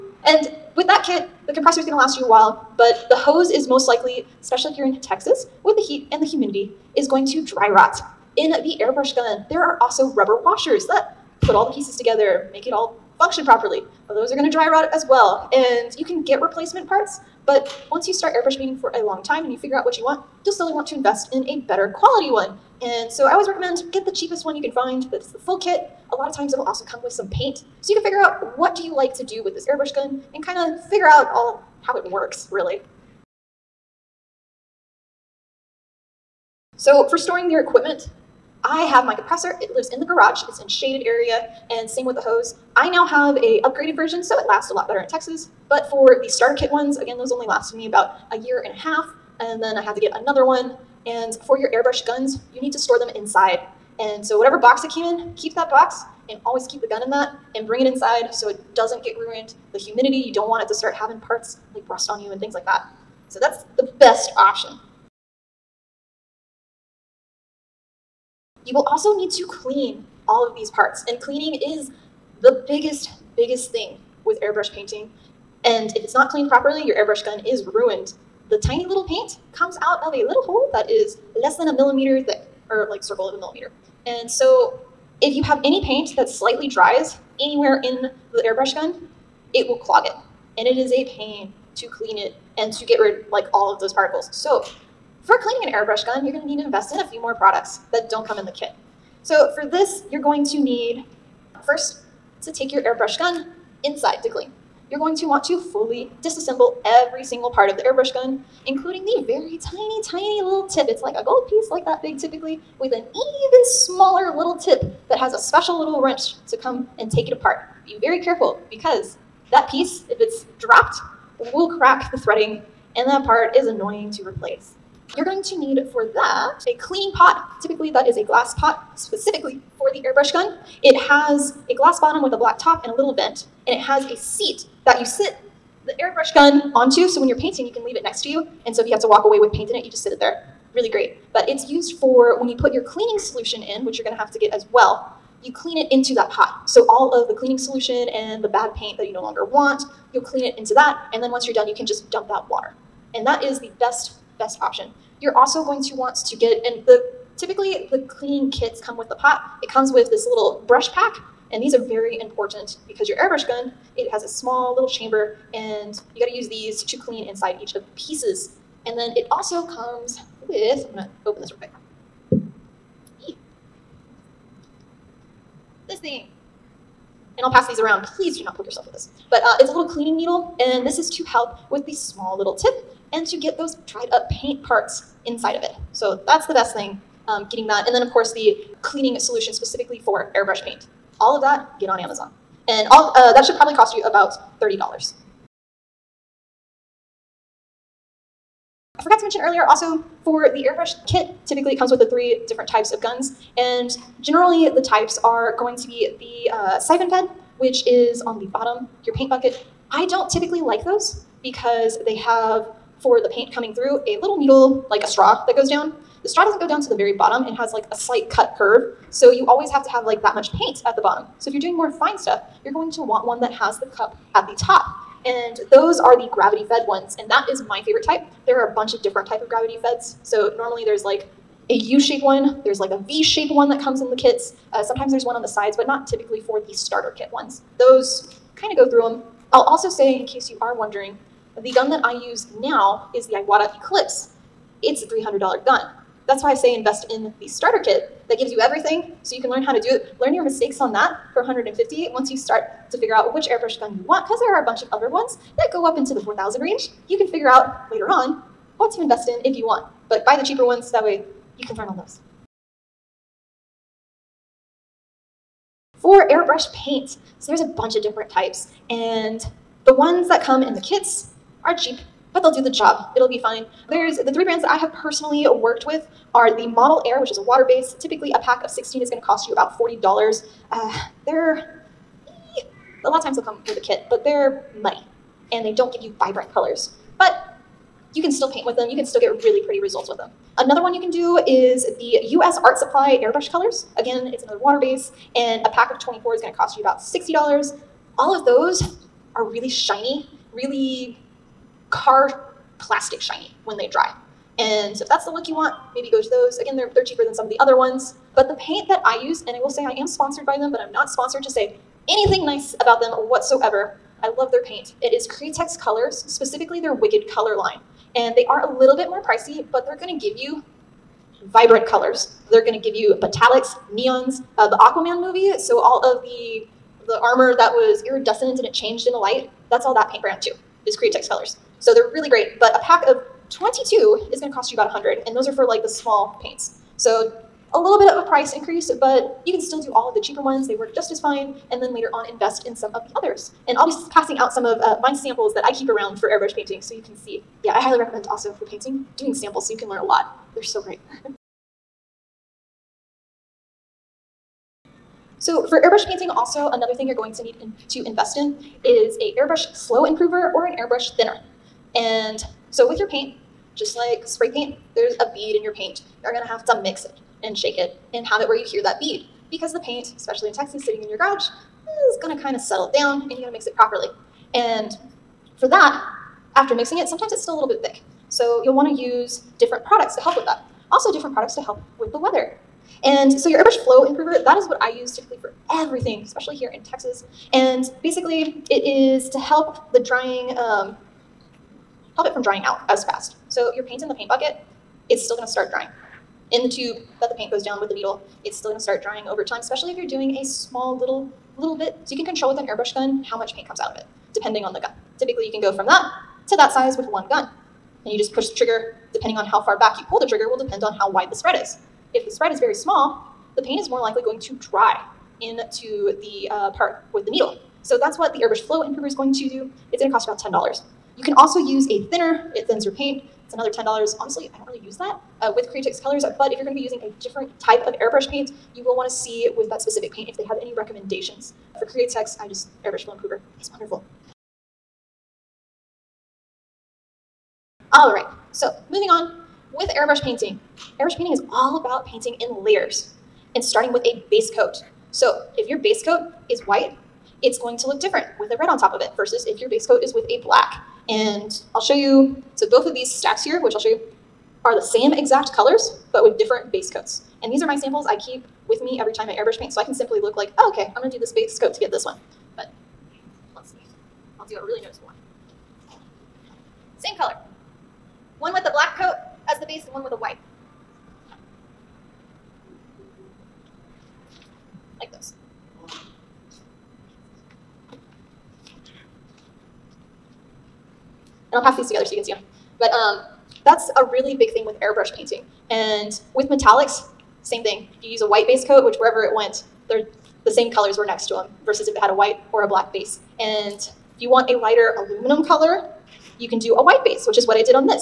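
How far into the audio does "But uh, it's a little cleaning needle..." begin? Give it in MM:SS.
02:59.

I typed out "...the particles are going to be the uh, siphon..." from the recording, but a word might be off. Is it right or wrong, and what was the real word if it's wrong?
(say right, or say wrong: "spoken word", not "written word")
wrong: "types", not "particles".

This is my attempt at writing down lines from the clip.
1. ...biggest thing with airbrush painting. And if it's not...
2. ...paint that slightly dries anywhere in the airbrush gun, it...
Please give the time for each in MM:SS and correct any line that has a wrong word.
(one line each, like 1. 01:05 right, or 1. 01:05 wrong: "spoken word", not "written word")
1. 01:13 right
2. 01:25 right.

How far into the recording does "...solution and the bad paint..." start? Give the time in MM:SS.
02:27.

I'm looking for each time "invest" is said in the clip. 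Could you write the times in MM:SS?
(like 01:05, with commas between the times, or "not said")
00:20, 01:36, 04:06, 04:19, 05:42, 05:58.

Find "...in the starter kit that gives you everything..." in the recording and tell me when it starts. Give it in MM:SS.
04:07.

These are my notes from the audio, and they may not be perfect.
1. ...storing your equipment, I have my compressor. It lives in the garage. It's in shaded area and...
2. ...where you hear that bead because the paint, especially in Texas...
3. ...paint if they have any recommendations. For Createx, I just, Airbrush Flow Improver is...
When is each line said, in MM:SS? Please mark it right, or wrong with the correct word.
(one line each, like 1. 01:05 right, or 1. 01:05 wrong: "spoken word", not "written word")
1. 00:37 right
2. 06:08 right
3. 07:10 right.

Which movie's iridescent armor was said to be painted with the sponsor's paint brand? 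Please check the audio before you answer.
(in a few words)
Aquaman.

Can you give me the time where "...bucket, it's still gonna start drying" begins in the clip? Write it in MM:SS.
06:34.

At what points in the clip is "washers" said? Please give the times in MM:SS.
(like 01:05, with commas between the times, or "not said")
00:10.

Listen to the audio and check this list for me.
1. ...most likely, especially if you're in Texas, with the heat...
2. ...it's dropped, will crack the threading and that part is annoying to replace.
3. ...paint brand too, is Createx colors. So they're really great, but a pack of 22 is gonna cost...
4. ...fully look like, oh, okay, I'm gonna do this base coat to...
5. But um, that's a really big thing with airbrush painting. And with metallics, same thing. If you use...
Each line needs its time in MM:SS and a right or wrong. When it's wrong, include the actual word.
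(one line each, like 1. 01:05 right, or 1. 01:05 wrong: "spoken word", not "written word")
1. 00:03 right
2. 02:00 right
3. 05:30 right
4. 07:39 wrong: "simply", not "fully"
5. 08:02 right.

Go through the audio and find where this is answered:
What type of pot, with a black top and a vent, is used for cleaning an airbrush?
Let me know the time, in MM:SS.
02:08.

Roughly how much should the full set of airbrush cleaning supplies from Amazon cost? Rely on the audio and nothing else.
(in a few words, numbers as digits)
$30.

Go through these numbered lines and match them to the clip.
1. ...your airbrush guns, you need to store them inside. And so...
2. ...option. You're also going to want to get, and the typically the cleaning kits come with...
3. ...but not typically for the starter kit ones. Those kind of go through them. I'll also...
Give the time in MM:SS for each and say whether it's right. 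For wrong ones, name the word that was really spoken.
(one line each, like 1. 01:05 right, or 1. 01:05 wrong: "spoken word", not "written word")
1. 00:51 right
2. 02:34 right
3. 03:55 right.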